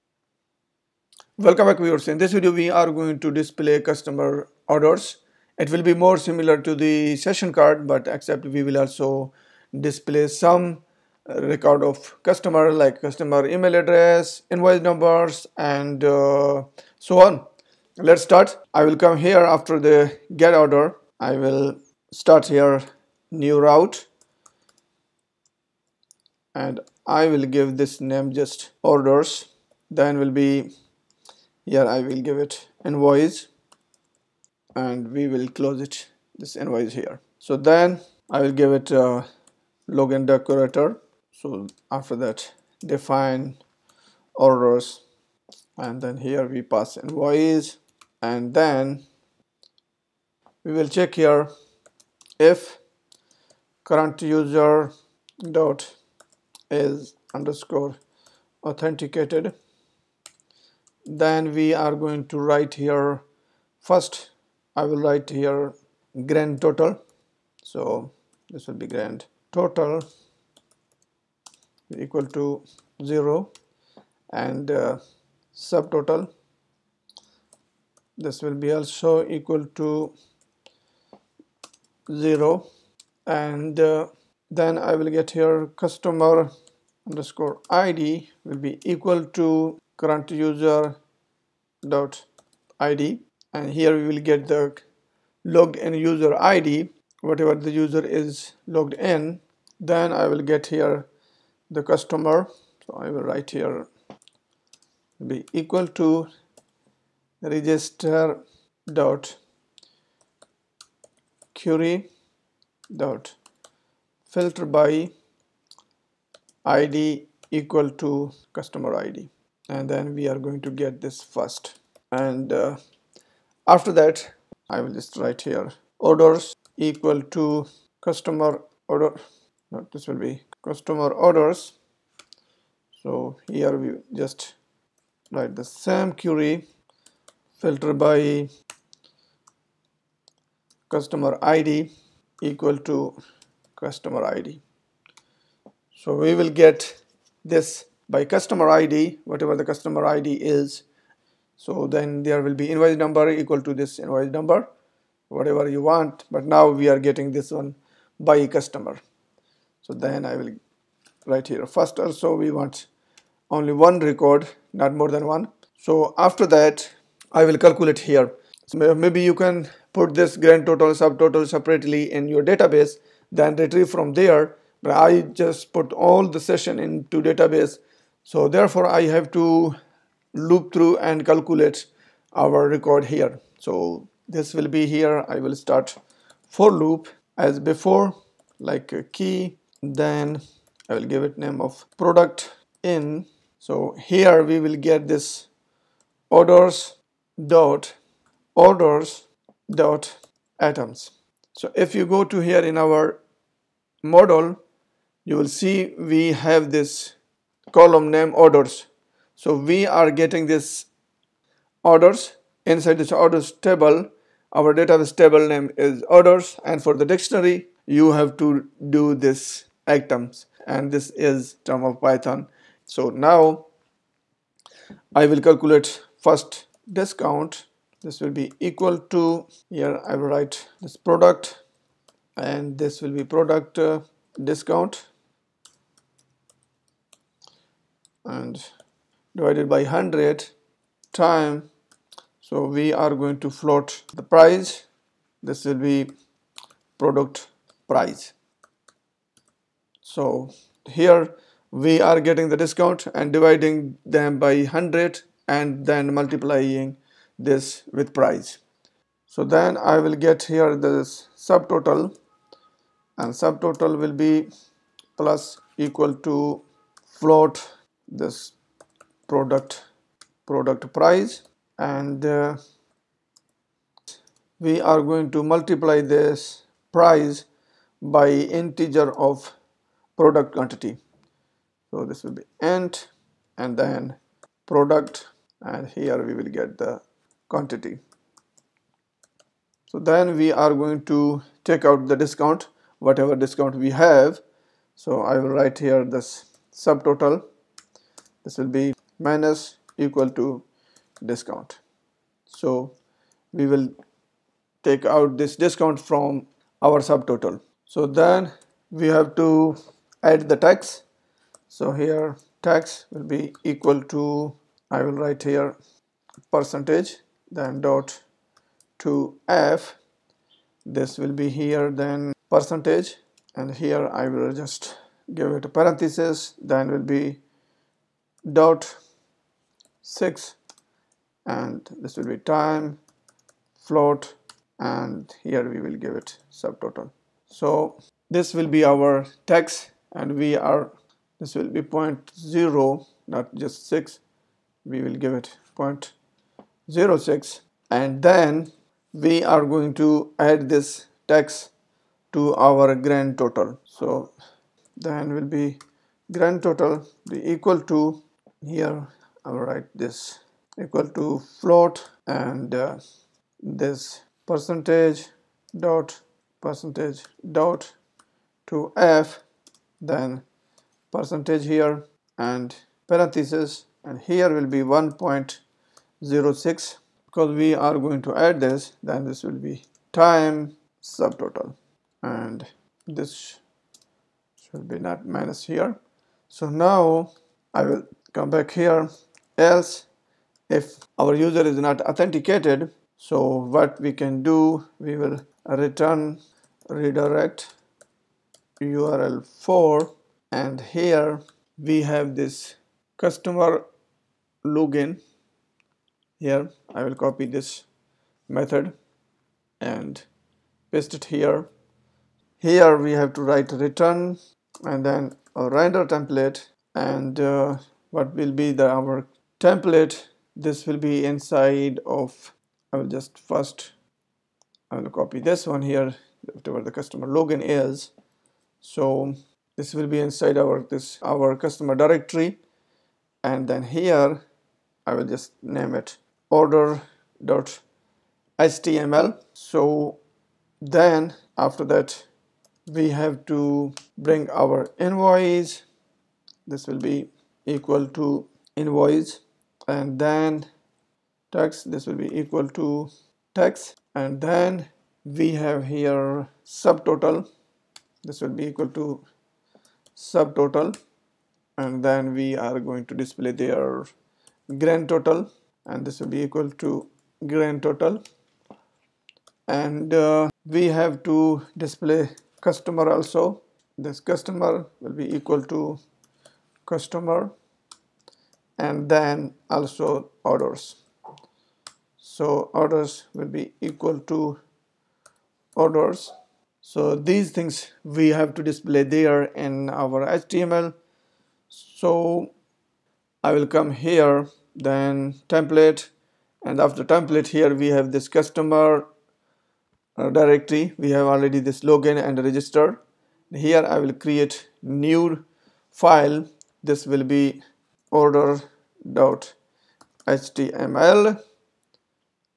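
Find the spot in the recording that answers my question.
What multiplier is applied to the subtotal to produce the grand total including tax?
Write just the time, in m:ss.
6:14.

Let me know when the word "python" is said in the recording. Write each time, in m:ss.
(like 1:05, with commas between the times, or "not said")
3:42.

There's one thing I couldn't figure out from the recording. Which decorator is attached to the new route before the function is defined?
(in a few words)
login decorator.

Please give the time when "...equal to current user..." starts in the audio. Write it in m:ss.
1:28.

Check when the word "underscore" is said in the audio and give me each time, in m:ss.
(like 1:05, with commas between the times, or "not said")
0:57, 1:27.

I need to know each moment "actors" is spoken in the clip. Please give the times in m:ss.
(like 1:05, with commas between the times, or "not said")
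not said.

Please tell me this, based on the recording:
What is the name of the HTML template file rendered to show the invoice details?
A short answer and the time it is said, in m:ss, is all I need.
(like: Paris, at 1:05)
order.html, at 8:28.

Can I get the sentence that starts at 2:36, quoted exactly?
But now we are getting this one by customer.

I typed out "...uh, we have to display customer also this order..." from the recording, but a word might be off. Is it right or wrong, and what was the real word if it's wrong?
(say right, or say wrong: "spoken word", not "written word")
wrong: "customer", not "order".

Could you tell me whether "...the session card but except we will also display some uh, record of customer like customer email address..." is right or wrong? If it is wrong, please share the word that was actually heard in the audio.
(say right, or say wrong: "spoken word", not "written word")
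right.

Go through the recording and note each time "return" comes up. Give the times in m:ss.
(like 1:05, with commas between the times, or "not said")
6:35, 6:53.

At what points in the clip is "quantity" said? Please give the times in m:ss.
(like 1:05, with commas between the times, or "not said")
4:40, 4:47.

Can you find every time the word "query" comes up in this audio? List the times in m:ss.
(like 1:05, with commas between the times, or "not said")
1:51, 2:16.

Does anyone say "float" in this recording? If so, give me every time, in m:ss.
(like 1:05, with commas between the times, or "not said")
4:03, 4:27, 5:33, 6:01.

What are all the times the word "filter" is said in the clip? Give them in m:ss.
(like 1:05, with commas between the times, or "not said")
1:54, 2:17.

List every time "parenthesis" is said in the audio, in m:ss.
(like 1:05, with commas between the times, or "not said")
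5:25, 6:13.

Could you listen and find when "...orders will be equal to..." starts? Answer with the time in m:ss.
8:02.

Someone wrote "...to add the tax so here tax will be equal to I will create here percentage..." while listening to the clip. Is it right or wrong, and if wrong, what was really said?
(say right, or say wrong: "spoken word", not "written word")
wrong: "write", not "create".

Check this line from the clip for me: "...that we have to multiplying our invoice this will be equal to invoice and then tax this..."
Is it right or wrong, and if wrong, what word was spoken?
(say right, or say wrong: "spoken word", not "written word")
wrong: "bring", not "multiplying".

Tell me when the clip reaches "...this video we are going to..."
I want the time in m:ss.
0:02.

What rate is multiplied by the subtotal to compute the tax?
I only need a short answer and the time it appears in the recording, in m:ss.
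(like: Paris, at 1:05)
0.06, at 5:46.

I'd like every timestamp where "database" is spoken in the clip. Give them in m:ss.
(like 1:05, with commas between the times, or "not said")
2:52, 2:57, 3:34.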